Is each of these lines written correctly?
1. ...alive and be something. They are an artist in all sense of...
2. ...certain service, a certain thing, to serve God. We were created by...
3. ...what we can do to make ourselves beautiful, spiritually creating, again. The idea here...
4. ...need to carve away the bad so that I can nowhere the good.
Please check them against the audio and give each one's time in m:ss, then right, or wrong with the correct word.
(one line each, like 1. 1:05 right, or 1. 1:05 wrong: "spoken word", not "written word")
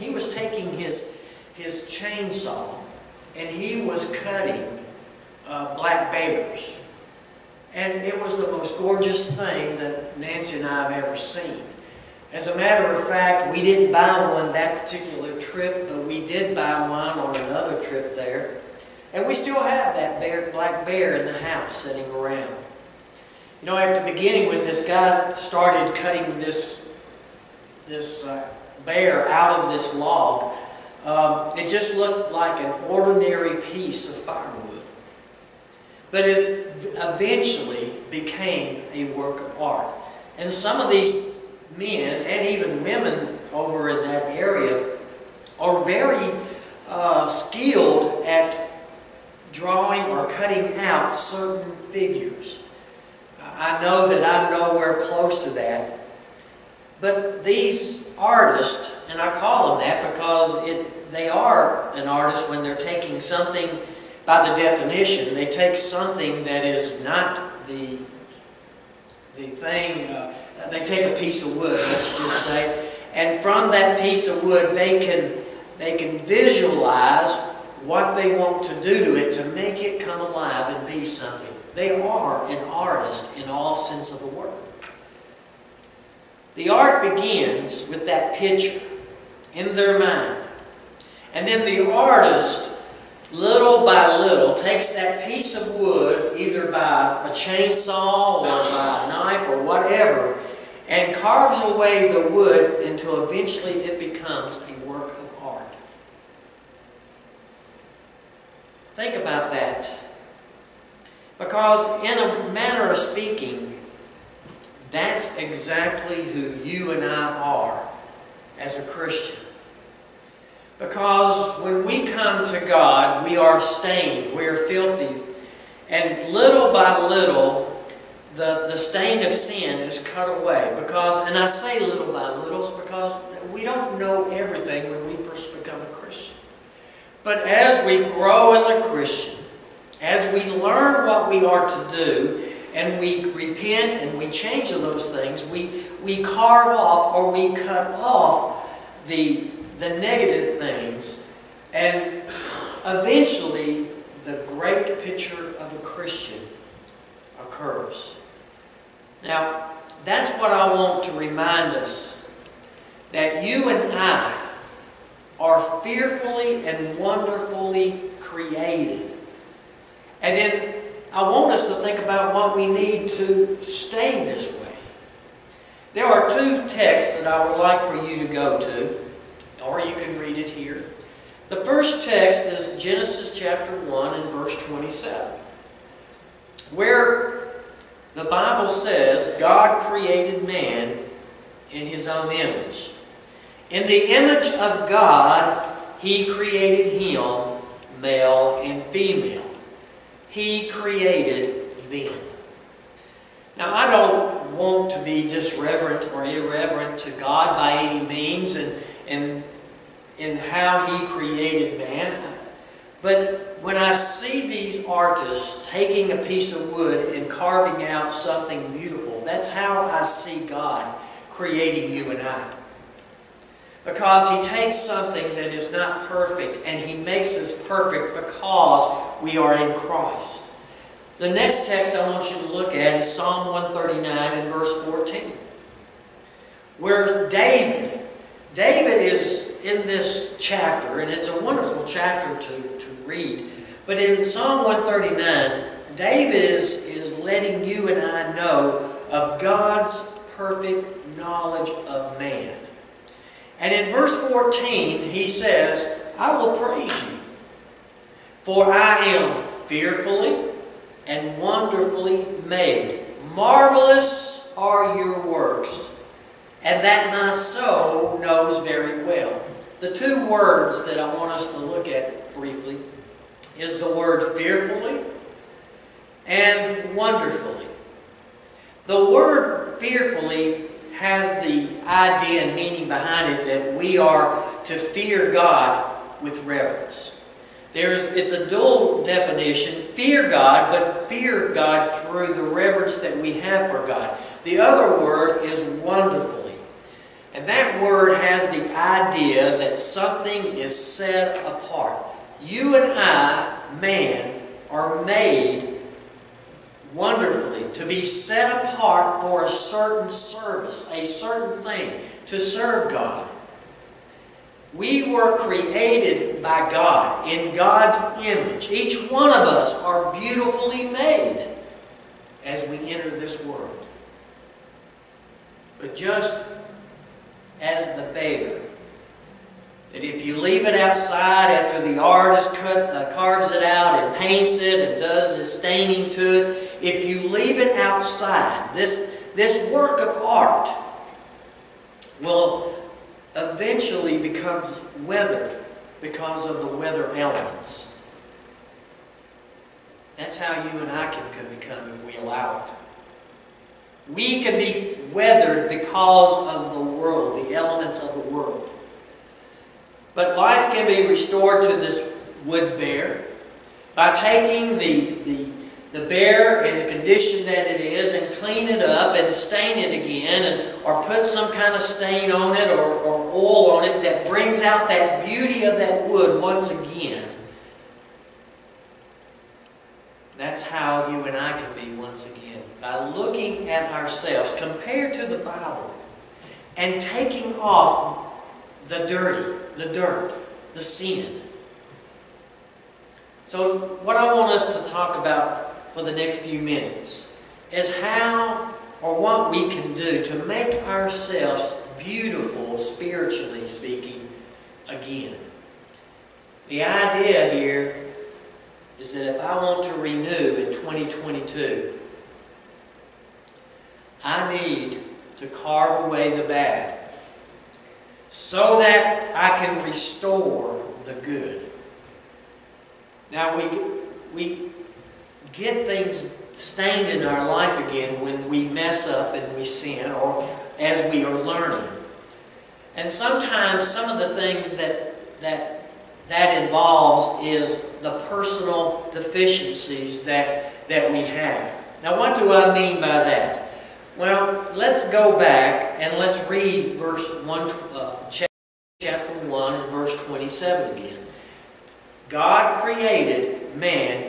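1. 1:20 right
2. 5:09 right
3. 6:39 wrong: "speaking", not "creating"
4. 6:54 wrong: "restore", not "nowhere".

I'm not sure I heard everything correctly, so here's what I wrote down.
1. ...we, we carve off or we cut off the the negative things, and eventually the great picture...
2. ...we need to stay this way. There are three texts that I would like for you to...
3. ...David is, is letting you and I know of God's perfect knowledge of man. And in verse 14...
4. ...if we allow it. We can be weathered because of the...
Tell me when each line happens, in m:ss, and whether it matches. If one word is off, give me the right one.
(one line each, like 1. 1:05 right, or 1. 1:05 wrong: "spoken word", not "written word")
1. 2:25 right
2. 2:52 wrong: "two", not "three"
3. 4:05 right
4. 5:51 right.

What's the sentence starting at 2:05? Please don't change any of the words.
And little by little, the, the stain of sin is cut away.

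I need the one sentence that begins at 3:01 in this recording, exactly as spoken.
The first text is Genesis chapter 1 and verse 27, where the Bible says God created man in his own image.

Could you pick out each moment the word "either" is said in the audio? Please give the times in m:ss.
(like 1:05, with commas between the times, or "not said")
1:36.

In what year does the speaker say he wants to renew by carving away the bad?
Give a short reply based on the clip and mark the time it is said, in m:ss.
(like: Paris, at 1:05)
2022, at 6:50.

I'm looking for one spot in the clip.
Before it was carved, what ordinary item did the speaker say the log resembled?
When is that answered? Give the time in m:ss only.
0:34.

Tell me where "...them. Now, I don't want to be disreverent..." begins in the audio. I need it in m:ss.
3:21.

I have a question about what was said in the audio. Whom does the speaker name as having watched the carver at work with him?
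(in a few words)
Nancy.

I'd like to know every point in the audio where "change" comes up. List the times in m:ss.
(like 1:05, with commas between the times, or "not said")
2:24.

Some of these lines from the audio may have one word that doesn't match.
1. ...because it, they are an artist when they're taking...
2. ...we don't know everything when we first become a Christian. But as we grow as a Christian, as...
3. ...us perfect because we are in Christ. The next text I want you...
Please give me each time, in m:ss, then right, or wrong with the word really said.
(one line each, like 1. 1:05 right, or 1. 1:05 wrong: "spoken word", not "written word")
1. 1:00 right
2. 2:13 right
3. 3:47 right.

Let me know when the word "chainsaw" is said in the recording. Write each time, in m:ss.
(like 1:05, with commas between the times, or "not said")
0:01, 1:37.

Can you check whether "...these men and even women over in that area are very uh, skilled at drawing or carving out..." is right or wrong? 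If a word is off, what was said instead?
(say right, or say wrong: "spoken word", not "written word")
wrong: "cutting", not "carving".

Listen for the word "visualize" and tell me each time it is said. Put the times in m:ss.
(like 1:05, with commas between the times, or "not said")
1:16.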